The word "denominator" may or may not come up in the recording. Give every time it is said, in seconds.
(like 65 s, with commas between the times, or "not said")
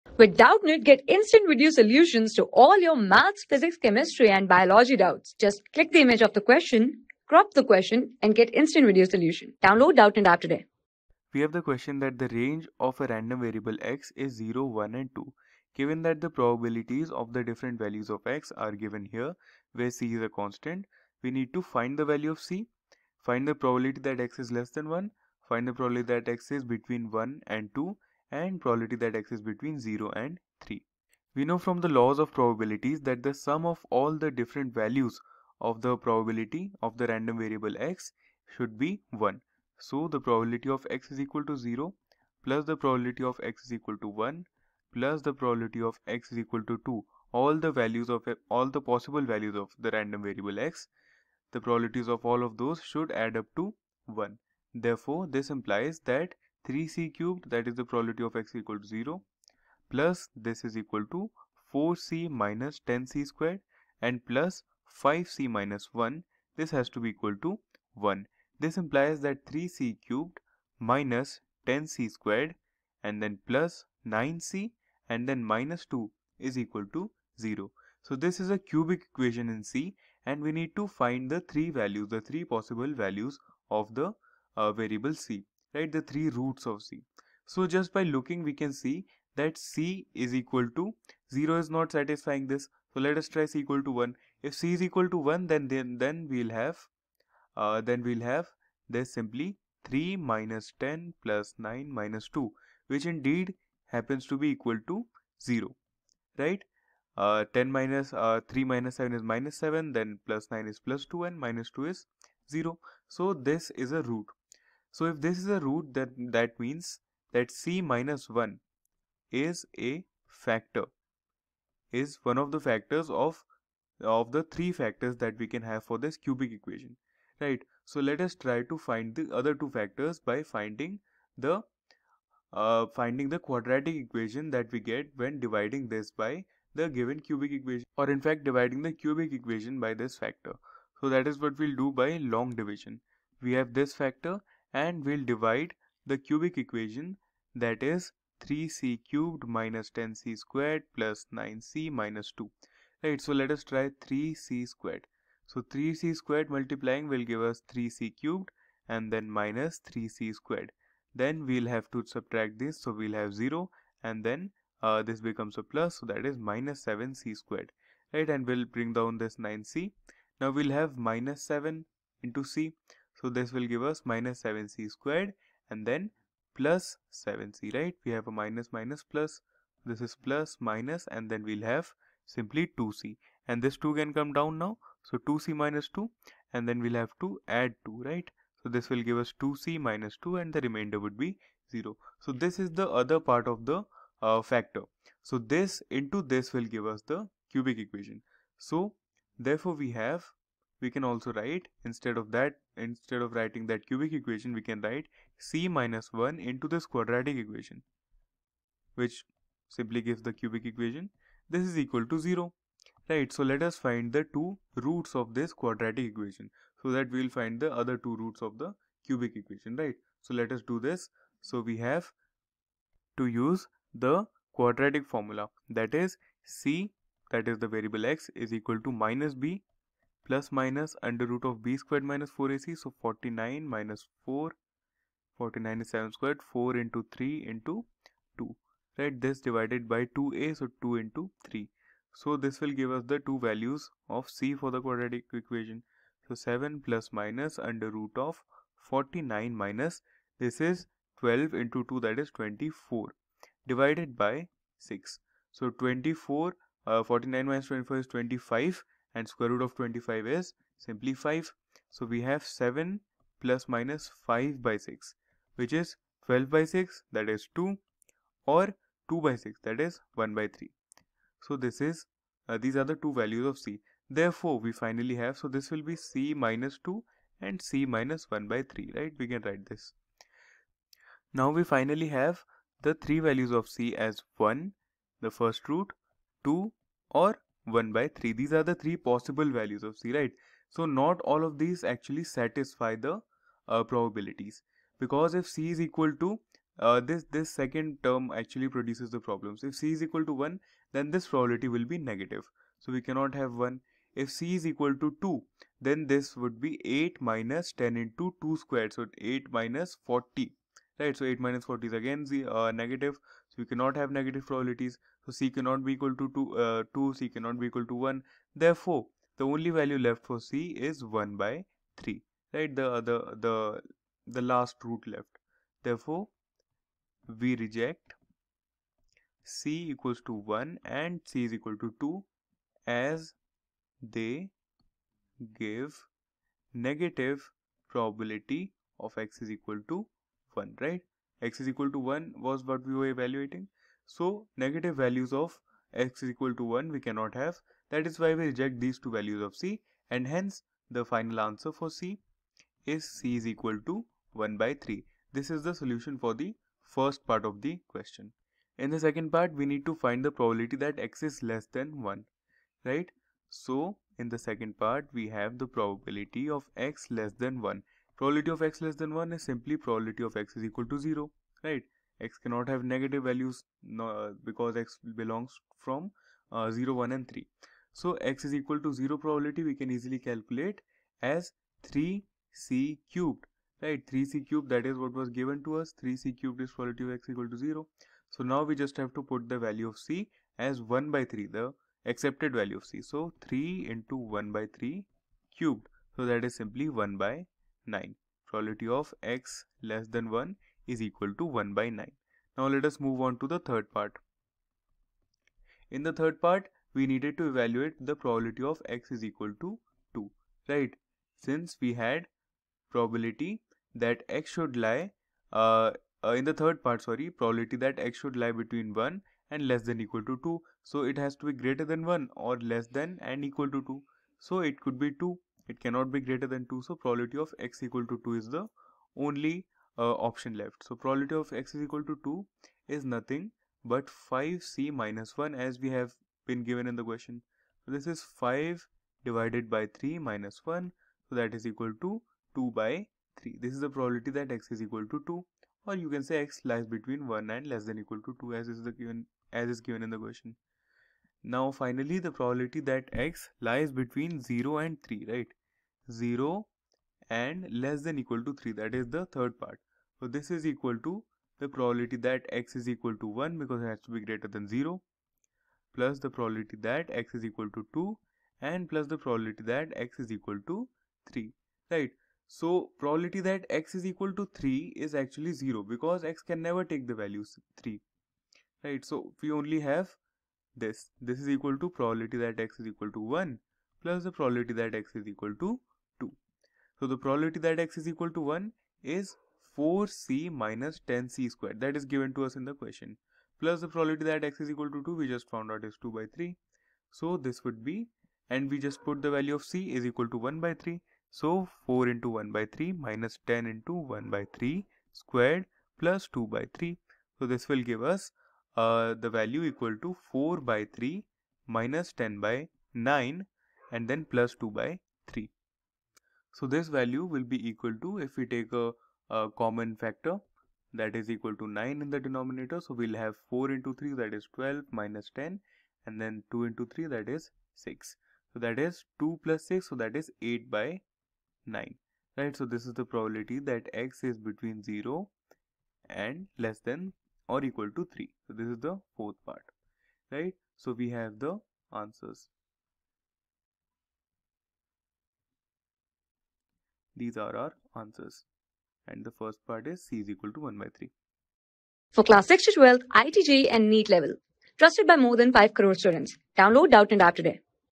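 522 s.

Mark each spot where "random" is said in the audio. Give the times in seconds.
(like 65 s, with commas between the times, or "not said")
13 s, 37 s, 49 s.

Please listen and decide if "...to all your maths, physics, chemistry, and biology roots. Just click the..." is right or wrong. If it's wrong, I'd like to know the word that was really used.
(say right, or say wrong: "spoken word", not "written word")
wrong: "doubts", not "roots".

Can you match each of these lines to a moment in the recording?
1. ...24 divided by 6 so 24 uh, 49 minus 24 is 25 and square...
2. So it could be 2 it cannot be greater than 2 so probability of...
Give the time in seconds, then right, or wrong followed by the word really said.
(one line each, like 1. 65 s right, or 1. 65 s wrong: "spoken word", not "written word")
1. 252 s right
2. 424 s right.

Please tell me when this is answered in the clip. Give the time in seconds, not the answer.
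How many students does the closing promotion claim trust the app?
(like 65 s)
555 s.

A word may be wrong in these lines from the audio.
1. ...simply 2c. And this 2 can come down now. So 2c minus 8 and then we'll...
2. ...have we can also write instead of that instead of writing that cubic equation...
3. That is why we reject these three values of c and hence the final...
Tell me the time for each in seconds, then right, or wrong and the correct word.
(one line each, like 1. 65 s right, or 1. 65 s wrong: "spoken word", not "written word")
1. 182 s wrong: "2", not "8"
2. 199 s right
3. 347 s wrong: "two", not "three".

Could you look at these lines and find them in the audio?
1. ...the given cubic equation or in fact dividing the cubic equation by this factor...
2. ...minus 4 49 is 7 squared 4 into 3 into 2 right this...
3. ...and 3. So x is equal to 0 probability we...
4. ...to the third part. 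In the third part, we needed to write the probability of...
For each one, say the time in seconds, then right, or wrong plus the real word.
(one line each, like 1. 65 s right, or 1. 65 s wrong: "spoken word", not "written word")
1. 136 s right
2. 233 s right
3. 377 s right
4. 403 s wrong: "evaluate", not "write".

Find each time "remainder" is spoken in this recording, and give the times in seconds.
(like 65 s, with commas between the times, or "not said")
190 s.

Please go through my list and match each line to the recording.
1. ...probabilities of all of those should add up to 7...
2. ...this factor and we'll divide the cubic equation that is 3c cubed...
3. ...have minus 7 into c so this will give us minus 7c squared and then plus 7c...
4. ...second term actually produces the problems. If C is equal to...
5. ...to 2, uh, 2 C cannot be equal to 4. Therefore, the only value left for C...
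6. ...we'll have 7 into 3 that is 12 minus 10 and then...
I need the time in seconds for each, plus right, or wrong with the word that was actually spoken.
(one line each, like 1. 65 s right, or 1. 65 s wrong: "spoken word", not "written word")
1. 51 s wrong: "1", not "7"
2. 143 s right
3. 170 s right
4. 297 s right
5. 316 s wrong: "1", not "4"
6. 522 s wrong: "4", not "7".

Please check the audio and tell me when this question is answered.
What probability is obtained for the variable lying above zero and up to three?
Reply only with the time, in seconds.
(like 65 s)
530 s.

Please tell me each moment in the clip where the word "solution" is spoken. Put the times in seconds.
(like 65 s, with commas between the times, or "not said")
1 s, 9 s, 355 s.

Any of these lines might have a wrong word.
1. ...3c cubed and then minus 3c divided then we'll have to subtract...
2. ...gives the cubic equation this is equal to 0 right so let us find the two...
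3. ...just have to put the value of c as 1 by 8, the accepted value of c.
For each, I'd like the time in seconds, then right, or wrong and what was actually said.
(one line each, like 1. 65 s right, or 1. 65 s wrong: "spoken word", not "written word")
1. 157 s wrong: "squared", not "divided"
2. 210 s right
3. 388 s wrong: "3", not "8".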